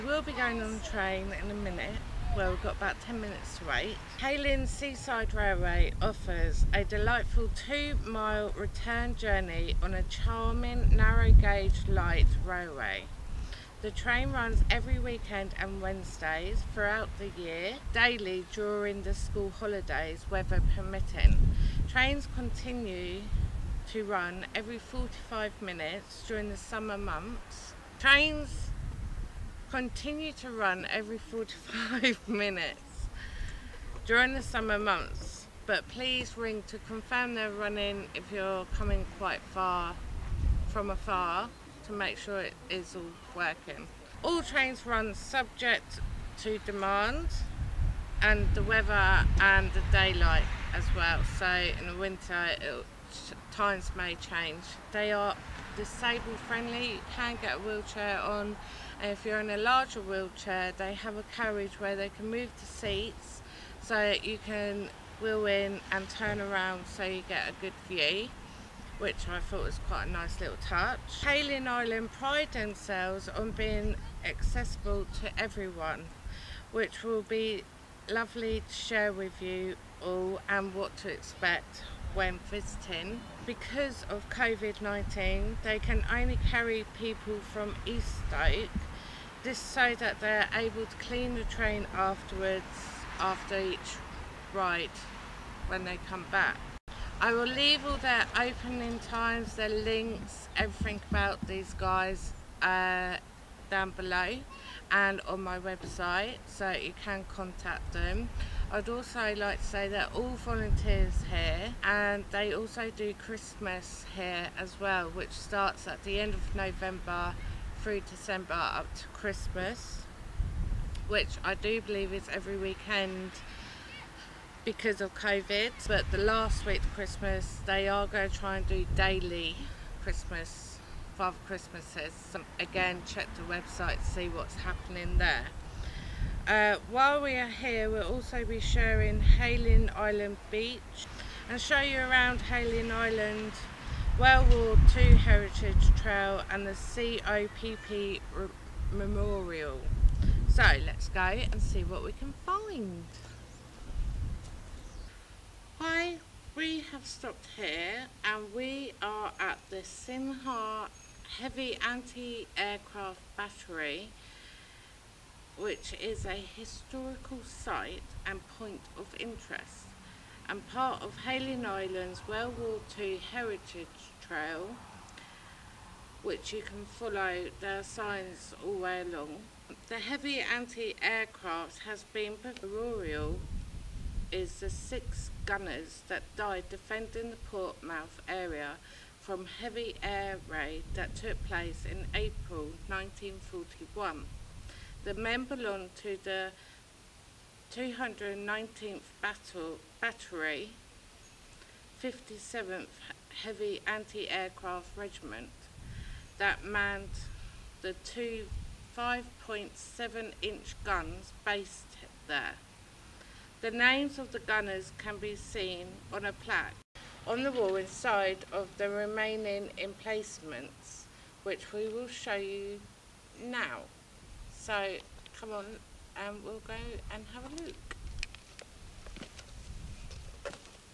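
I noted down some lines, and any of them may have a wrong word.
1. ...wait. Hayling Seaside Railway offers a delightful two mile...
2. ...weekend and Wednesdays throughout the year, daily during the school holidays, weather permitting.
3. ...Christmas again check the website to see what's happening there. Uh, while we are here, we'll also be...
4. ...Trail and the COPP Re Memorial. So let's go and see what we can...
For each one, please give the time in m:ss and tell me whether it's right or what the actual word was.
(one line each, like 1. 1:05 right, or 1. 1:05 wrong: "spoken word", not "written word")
1. 0:03 right
2. 0:14 right
3. 2:11 right
4. 2:25 right.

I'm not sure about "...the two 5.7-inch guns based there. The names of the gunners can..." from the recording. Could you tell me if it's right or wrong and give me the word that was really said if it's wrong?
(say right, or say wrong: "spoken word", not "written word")
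right.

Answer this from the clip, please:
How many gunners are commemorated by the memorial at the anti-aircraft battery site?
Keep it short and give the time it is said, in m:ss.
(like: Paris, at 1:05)
6, at 3:04.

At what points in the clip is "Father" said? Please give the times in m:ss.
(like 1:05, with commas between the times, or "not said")
2:11.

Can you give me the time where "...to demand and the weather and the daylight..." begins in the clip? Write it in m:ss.
0:46.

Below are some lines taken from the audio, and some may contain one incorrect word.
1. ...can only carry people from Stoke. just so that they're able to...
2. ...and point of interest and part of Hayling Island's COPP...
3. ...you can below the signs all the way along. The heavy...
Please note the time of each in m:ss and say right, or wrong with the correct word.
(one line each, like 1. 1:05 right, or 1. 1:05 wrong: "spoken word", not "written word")
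1. 1:25 right
2. 2:48 wrong: "World", not "COPP"
3. 2:56 wrong: "follow", not "below".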